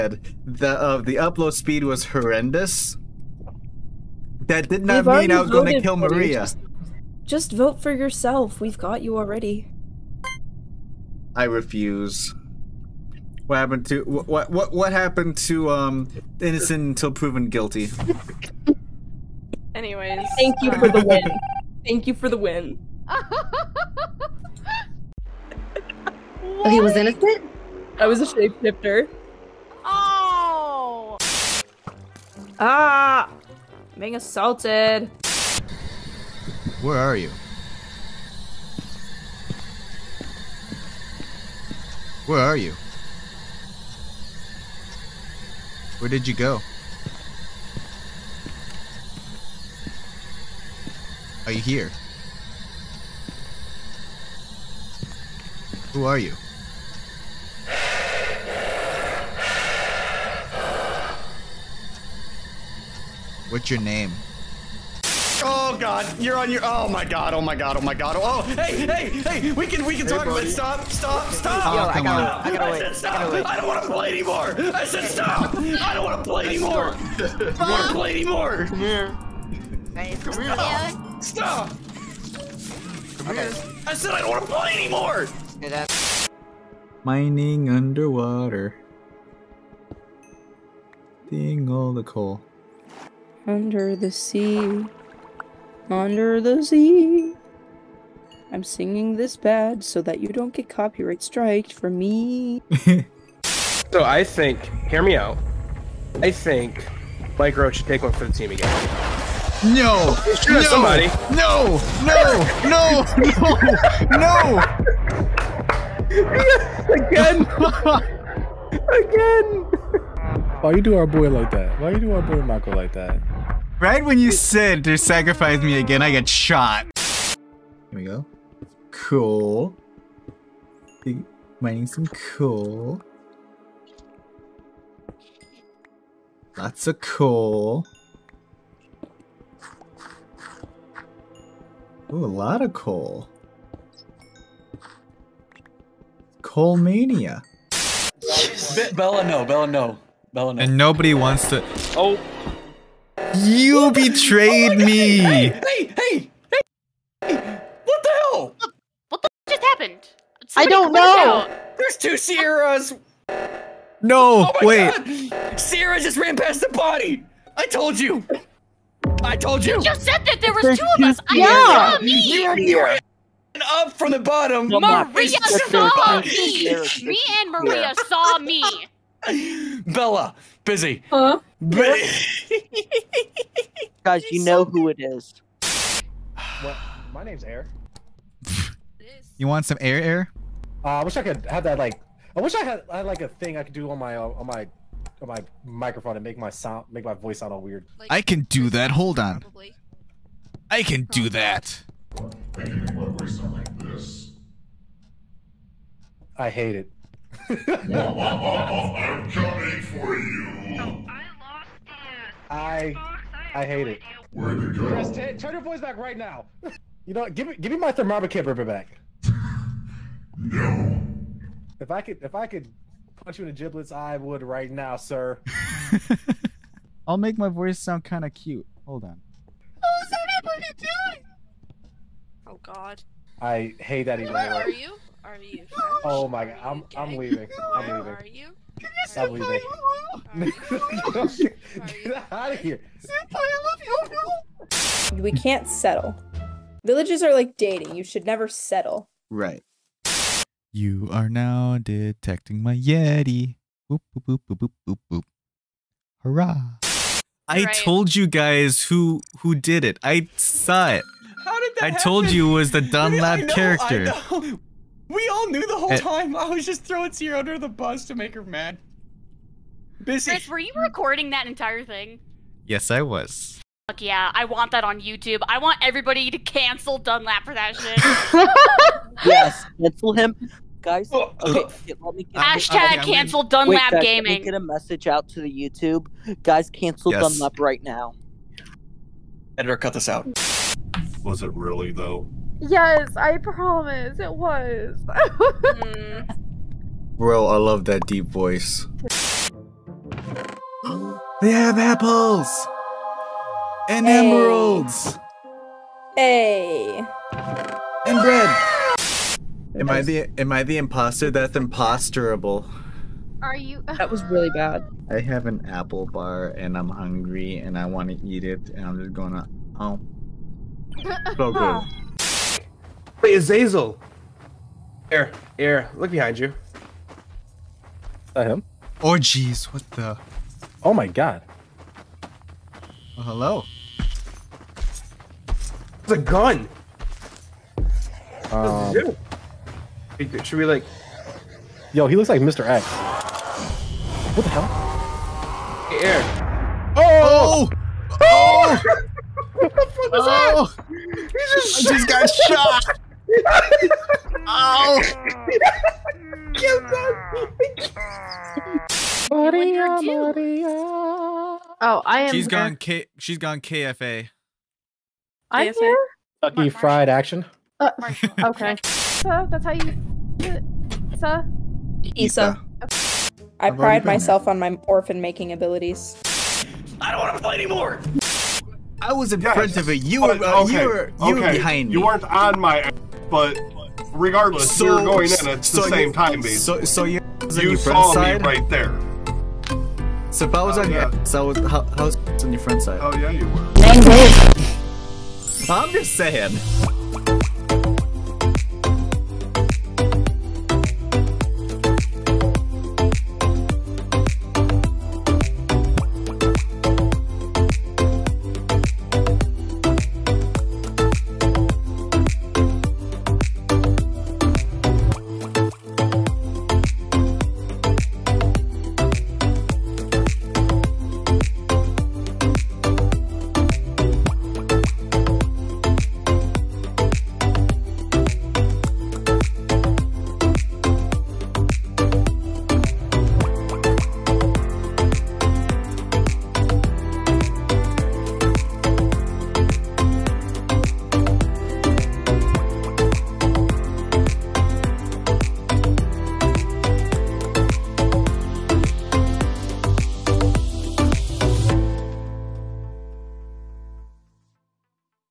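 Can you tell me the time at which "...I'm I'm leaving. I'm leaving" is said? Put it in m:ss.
3:56.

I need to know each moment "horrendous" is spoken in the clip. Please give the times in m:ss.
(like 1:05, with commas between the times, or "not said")
0:02.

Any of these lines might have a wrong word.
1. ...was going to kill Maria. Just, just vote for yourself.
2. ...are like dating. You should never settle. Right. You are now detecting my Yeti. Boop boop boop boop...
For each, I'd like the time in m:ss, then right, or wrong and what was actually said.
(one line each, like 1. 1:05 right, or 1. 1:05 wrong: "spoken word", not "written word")
1. 0:05 right
2. 4:07 right.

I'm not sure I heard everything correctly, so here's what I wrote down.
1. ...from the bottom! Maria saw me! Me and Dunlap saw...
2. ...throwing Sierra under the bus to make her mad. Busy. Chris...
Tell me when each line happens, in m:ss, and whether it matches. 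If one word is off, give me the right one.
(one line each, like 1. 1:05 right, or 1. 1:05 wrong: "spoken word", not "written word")
1. 2:53 wrong: "Maria", not "Dunlap"
2. 4:26 right.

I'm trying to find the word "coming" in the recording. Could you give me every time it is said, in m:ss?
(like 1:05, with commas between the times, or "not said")
3:29.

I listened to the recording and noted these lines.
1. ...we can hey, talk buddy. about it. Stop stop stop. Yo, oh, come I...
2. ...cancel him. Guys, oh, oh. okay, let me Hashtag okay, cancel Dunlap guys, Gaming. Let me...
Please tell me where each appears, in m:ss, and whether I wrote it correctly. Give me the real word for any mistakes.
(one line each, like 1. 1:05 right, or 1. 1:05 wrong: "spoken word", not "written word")
1. 1:09 right
2. 4:39 right.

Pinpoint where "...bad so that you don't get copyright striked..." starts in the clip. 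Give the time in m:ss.
1:39.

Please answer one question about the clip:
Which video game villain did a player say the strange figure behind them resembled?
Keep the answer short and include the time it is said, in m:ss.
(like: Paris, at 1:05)
Mr. X, at 5:42.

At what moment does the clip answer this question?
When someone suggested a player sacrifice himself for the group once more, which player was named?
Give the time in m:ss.
1:47.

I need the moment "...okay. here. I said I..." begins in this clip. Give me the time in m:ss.
1:23.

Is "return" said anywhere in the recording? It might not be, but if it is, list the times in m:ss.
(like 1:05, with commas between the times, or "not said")
not said.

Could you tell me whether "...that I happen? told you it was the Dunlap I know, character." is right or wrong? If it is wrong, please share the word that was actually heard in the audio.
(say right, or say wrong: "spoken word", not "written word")
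right.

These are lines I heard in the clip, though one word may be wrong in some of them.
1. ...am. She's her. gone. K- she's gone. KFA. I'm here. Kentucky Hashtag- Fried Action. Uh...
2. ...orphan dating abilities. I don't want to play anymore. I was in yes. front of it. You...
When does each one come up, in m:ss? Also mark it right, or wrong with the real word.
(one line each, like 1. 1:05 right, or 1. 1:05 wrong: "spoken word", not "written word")
1. 6:02 wrong: "Mar", not "Hashtag"
2. 6:14 wrong: "making", not "dating".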